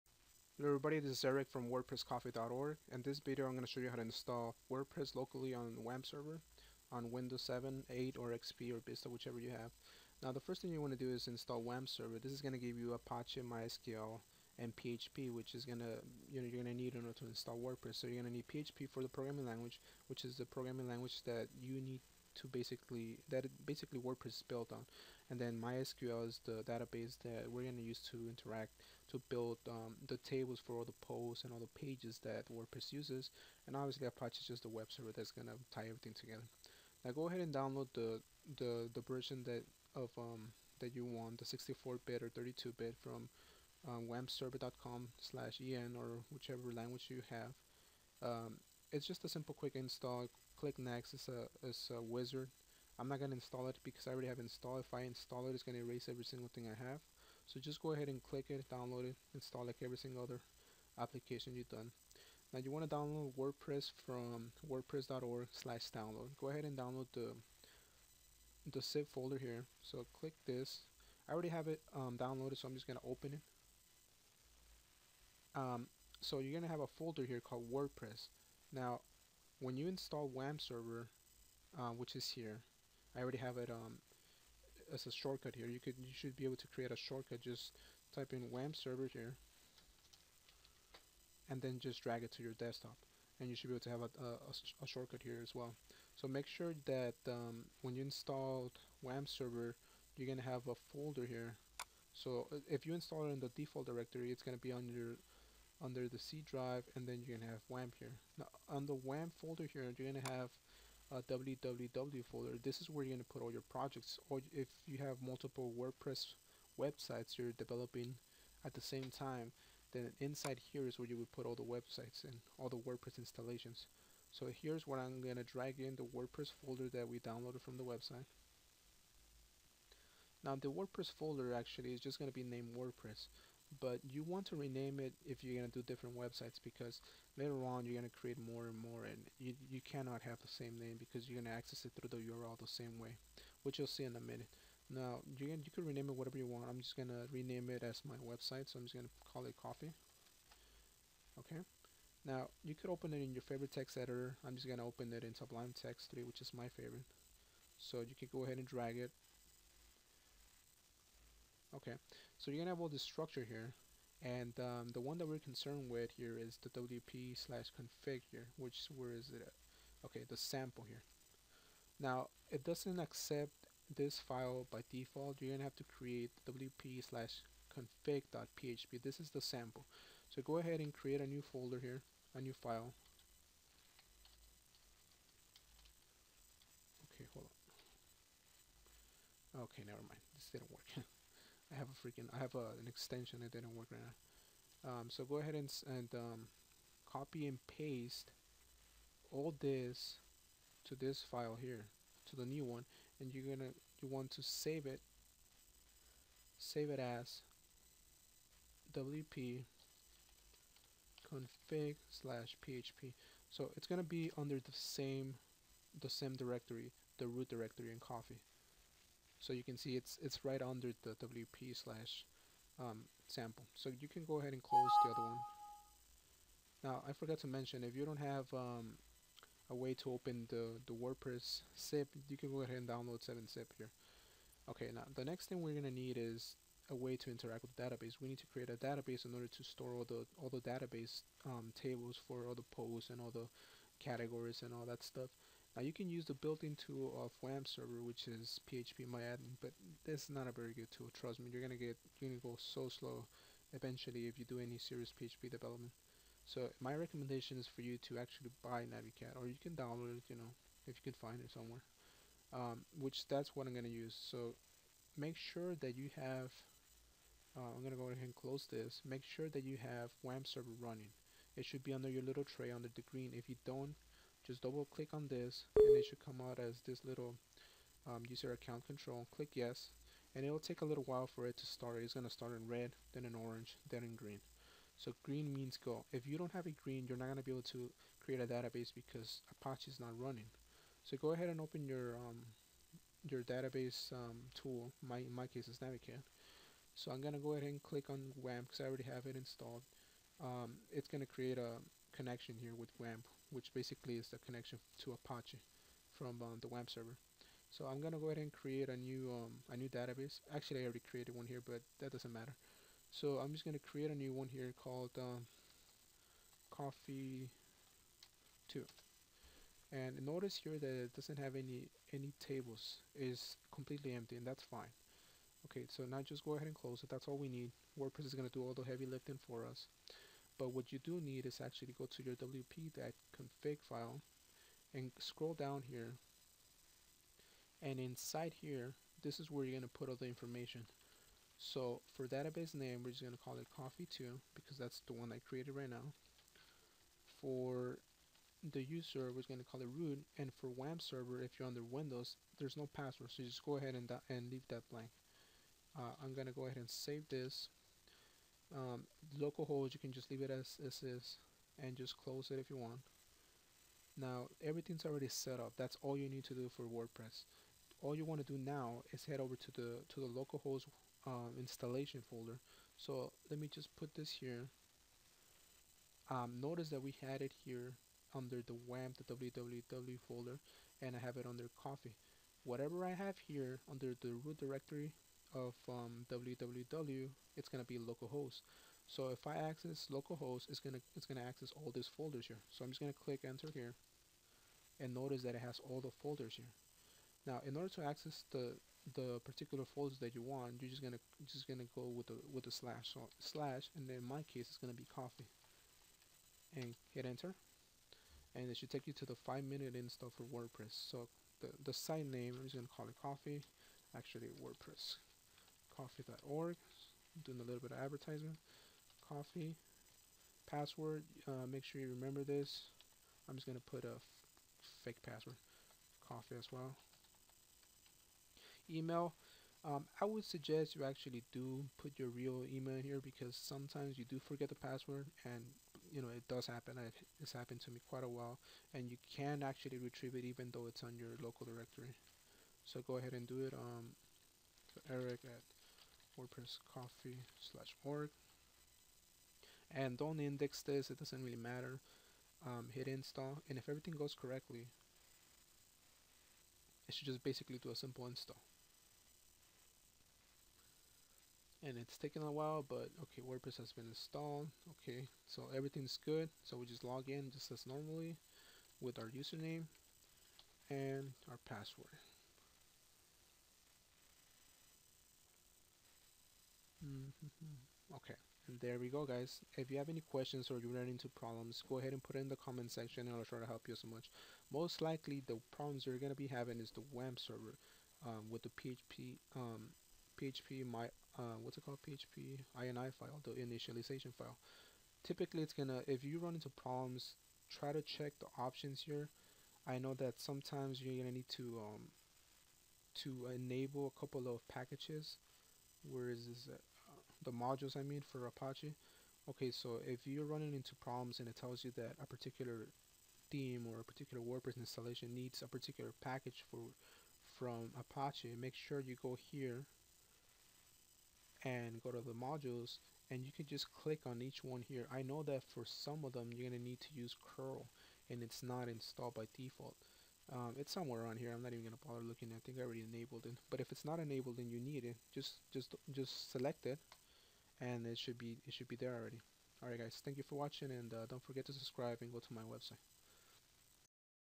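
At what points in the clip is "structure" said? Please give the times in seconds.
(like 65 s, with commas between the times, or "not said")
163 s.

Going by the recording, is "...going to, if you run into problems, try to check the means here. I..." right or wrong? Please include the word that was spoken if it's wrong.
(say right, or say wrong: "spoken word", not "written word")
wrong: "options", not "means".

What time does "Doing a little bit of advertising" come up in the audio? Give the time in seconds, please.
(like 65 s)
417 s.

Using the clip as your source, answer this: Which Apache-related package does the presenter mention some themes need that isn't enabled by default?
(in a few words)
curl.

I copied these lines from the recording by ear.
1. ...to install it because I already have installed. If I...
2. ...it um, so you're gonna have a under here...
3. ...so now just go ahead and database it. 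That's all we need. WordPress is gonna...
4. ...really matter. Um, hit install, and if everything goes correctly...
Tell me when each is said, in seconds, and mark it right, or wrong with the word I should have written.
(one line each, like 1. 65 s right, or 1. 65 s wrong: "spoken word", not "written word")
1. 53 s right
2. 73 s wrong: "folder", not "under"
3. 325 s wrong: "close", not "database"
4. 451 s right.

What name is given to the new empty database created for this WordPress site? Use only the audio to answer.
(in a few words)
Coffee Two.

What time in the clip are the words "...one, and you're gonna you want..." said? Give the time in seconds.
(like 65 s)
202 s.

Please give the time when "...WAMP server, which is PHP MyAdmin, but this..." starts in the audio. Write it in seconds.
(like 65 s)
247 s.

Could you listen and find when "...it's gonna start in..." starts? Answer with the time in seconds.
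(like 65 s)
282 s.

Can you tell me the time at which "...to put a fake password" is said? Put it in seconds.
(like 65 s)
423 s.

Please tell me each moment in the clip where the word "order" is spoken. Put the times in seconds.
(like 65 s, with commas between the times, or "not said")
17 s, 239 s, 397 s.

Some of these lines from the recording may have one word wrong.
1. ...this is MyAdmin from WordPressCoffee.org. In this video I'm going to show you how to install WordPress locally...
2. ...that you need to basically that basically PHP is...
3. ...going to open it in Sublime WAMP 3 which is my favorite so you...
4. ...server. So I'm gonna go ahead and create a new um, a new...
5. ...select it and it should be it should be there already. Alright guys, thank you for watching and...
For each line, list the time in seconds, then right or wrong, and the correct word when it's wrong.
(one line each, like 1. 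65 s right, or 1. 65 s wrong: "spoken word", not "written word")
1. 0 s wrong: "Eric", not "MyAdmin"
2. 21 s wrong: "WordPress", not "PHP"
3. 154 s wrong: "Text", not "WAMP"
4. 306 s right
5. 536 s right.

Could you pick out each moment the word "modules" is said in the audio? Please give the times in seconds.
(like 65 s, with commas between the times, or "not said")
507 s, 522 s.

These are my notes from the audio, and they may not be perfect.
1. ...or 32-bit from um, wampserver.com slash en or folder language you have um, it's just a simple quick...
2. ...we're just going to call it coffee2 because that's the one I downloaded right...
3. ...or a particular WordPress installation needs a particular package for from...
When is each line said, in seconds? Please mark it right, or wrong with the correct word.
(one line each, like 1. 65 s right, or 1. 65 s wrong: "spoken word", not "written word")
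1. 42 s wrong: "whichever", not "folder"
2. 343 s wrong: "created", not "downloaded"
3. 513 s right.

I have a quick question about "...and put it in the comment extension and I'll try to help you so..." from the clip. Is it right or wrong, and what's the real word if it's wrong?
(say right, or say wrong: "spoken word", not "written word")
wrong: "section", not "extension".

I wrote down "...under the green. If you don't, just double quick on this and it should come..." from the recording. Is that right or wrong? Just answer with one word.
wrong.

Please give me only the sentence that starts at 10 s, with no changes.
Now the first thing you want to do is install WAMP server.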